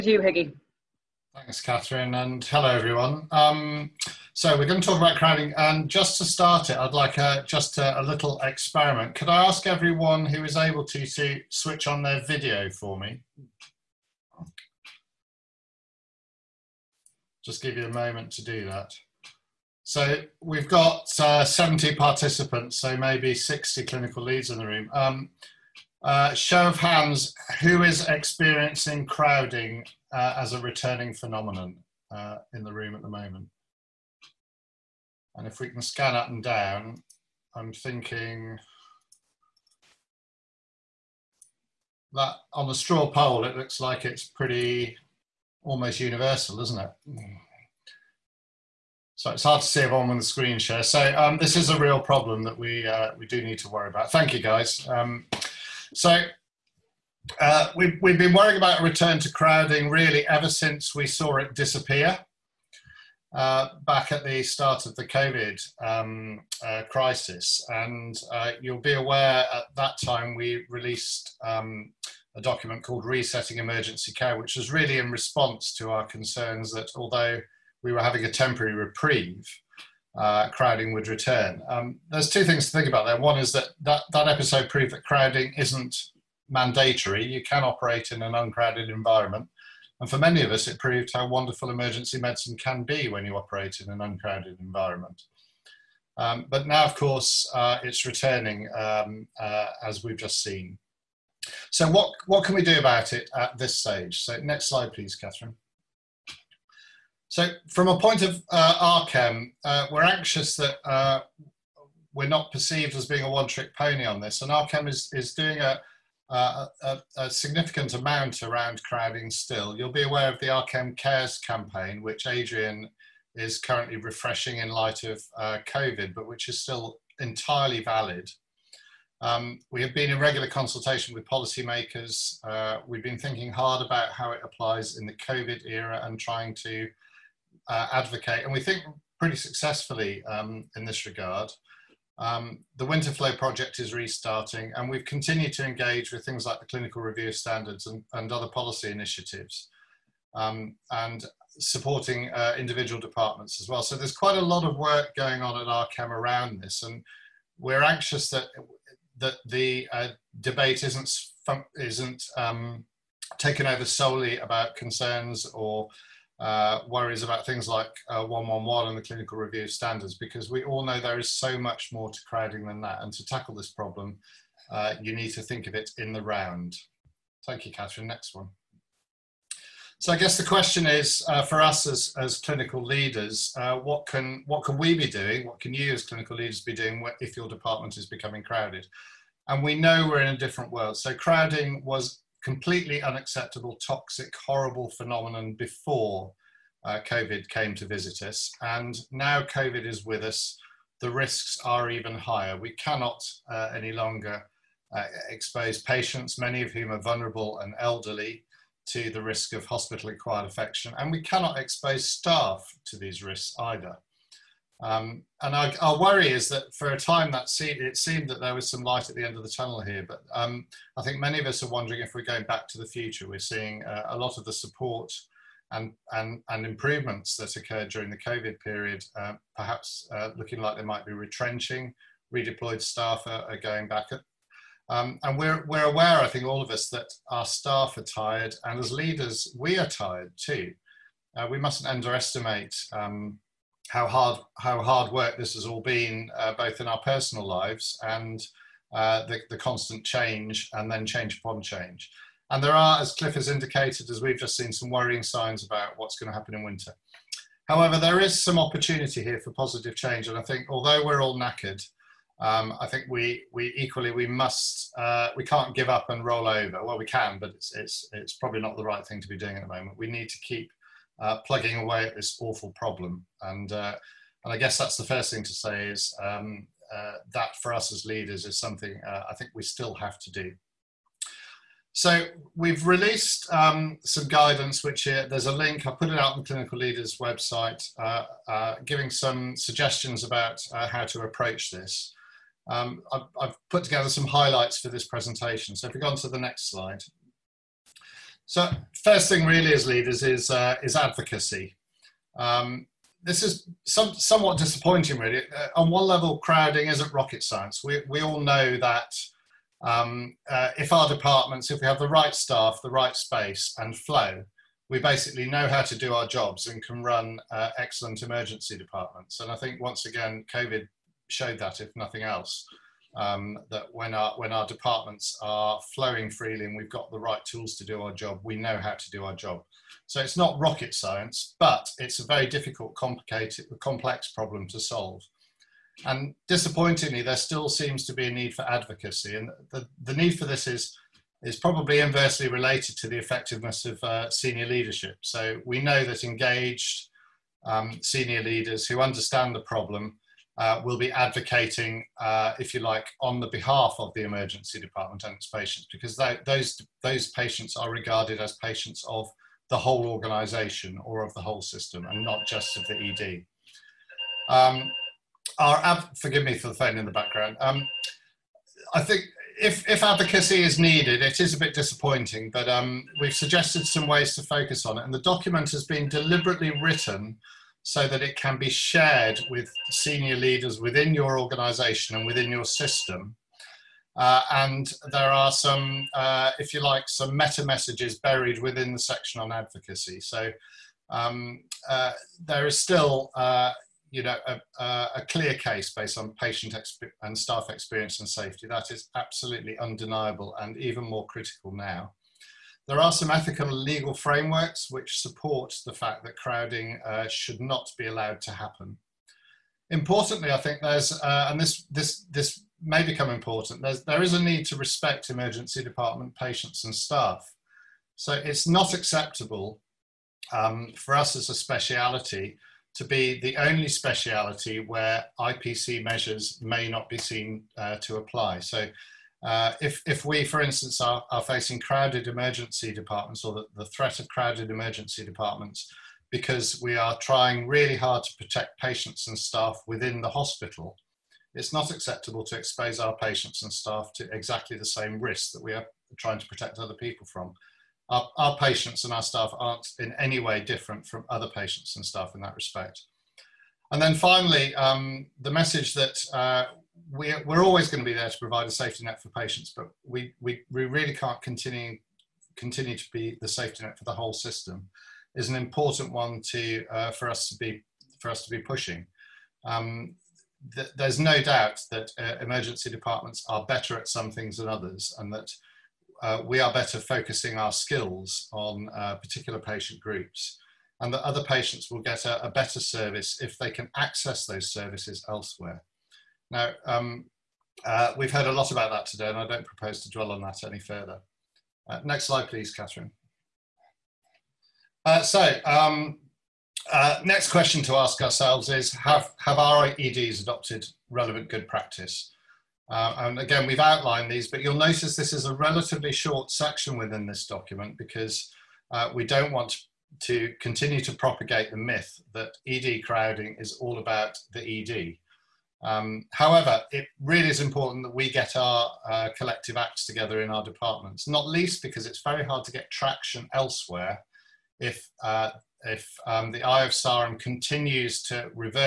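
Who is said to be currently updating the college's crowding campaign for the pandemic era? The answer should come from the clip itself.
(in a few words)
Adrian.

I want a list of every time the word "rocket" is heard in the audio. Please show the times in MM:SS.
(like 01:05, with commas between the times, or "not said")
05:07, 05:30.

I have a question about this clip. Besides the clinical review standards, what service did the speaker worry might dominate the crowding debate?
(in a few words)
111.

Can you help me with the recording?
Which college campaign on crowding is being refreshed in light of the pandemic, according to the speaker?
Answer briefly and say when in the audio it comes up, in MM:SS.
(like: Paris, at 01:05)
RCEM Cares, at 02:00.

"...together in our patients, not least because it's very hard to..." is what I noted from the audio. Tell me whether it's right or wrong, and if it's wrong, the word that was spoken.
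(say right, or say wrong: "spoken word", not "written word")
wrong: "departments", not "patients".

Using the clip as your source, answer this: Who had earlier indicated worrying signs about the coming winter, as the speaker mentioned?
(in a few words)
Cliff.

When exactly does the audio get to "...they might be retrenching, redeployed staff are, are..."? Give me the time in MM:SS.
03:50.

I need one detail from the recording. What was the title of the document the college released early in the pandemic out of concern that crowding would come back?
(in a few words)
Resetting Emergency Care.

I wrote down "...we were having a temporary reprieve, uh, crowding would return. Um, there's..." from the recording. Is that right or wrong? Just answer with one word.
right.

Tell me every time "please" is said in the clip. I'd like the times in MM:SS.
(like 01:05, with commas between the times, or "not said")
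01:44, 08:12.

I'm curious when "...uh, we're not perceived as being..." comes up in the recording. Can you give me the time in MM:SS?
01:50.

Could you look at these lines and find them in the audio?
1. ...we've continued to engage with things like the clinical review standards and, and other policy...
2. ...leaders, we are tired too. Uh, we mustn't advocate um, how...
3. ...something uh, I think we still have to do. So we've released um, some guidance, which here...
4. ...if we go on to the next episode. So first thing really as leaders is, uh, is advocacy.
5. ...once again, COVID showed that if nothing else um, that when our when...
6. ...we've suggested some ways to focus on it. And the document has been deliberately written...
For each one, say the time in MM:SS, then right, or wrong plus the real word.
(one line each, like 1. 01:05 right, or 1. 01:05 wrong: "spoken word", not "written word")
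1. 02:24 right
2. 03:58 wrong: "underestimate", not "advocate"
3. 04:38 right
4. 04:55 wrong: "slide", not "episode"
5. 05:19 right
6. 06:13 right.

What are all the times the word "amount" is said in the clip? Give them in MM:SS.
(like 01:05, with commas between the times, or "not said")
01:57.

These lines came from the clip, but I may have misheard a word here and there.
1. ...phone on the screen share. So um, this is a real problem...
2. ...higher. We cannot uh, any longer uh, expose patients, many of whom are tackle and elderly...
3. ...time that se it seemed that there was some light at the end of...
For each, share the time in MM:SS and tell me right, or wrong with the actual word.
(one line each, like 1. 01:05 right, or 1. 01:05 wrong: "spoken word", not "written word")
1. 00:49 wrong: "everyone", not "phone"
2. 03:22 wrong: "vulnerable", not "tackle"
3. 03:36 right.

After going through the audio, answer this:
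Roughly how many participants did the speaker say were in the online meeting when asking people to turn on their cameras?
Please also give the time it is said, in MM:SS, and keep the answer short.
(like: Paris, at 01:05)
70, at 00:21.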